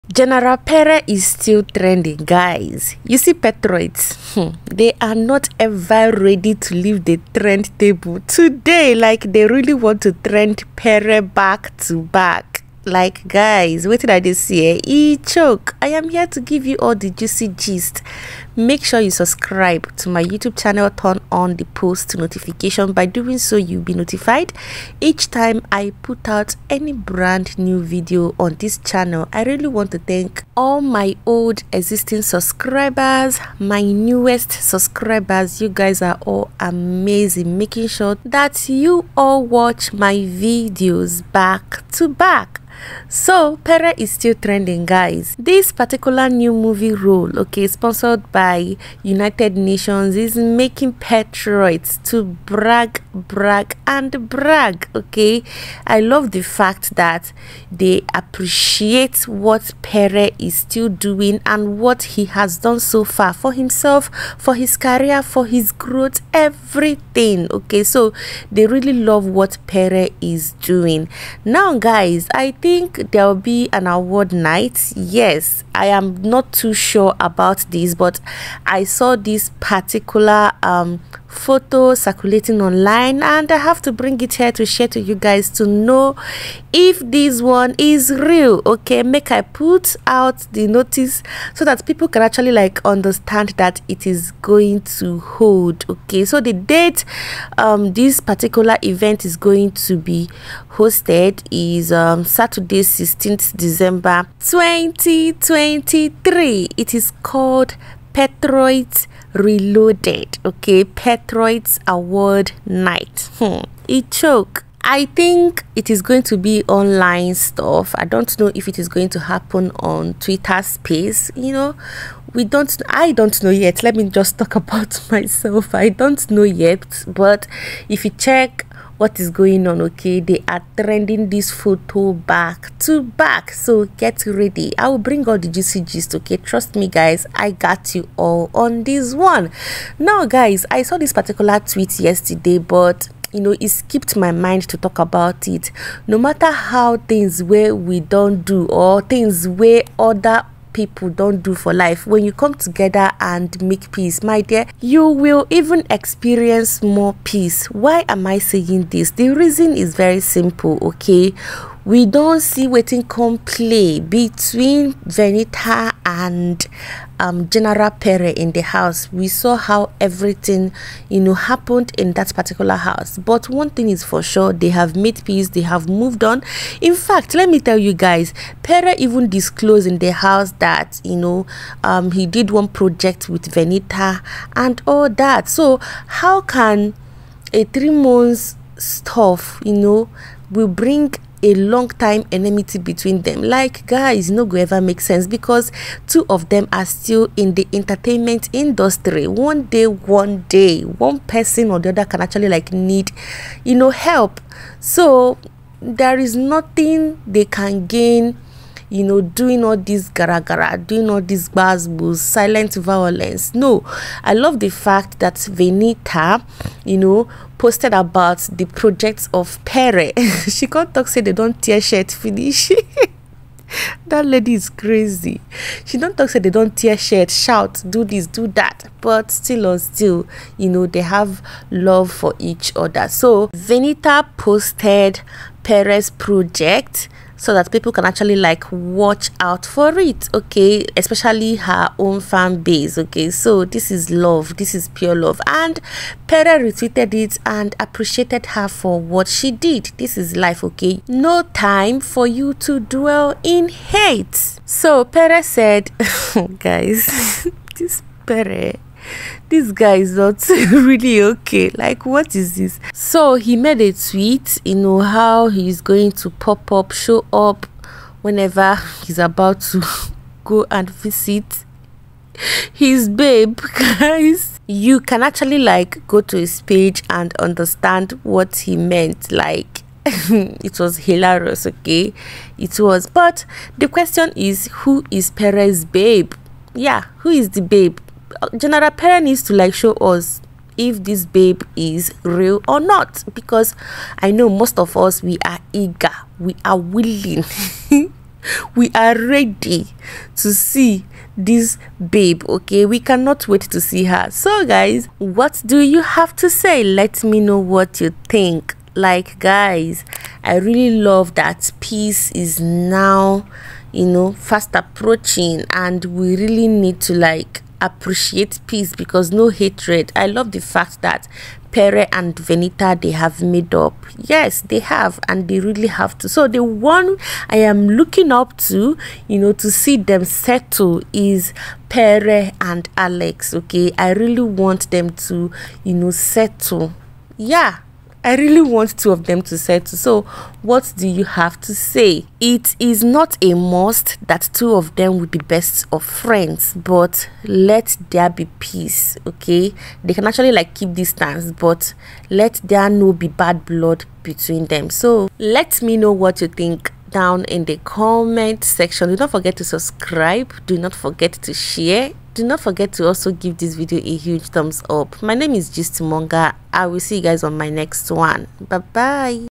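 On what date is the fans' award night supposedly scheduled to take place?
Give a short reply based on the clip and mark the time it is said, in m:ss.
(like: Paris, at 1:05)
Saturday 16th December 2023, at 1:42.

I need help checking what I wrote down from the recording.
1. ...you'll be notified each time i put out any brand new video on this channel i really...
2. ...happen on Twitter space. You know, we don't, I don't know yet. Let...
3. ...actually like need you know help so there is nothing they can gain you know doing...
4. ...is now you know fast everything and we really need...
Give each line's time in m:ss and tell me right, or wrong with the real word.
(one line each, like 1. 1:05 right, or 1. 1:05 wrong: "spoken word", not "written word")
1. 0:23 right
2. 1:59 right
3. 3:22 right
4. 5:12 wrong: "approaching", not "everything".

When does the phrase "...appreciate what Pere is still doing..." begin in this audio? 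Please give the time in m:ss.
0:58.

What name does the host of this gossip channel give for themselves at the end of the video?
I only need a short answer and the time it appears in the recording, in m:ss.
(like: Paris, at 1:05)
Gist Monger, at 6:05.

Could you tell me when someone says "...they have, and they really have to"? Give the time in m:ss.
5:24.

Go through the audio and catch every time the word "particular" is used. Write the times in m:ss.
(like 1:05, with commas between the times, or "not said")
0:45, 1:19, 1:38, 2:21, 2:52.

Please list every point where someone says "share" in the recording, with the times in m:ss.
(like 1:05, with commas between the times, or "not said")
1:24, 6:01.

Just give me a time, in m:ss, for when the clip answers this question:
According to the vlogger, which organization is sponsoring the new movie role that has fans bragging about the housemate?
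0:49.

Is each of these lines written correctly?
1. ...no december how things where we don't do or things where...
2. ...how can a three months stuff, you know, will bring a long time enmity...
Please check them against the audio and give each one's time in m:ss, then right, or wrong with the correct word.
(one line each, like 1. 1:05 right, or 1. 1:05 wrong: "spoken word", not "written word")
1. 2:26 wrong: "matter", not "december"
2. 3:05 right.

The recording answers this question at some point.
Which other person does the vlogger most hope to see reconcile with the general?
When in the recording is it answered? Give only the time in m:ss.
5:32.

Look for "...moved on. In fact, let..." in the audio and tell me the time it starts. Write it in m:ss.
2:55.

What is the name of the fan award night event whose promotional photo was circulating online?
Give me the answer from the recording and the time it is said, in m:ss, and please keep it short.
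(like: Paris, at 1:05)
Patriots Reloaded, at 1:48.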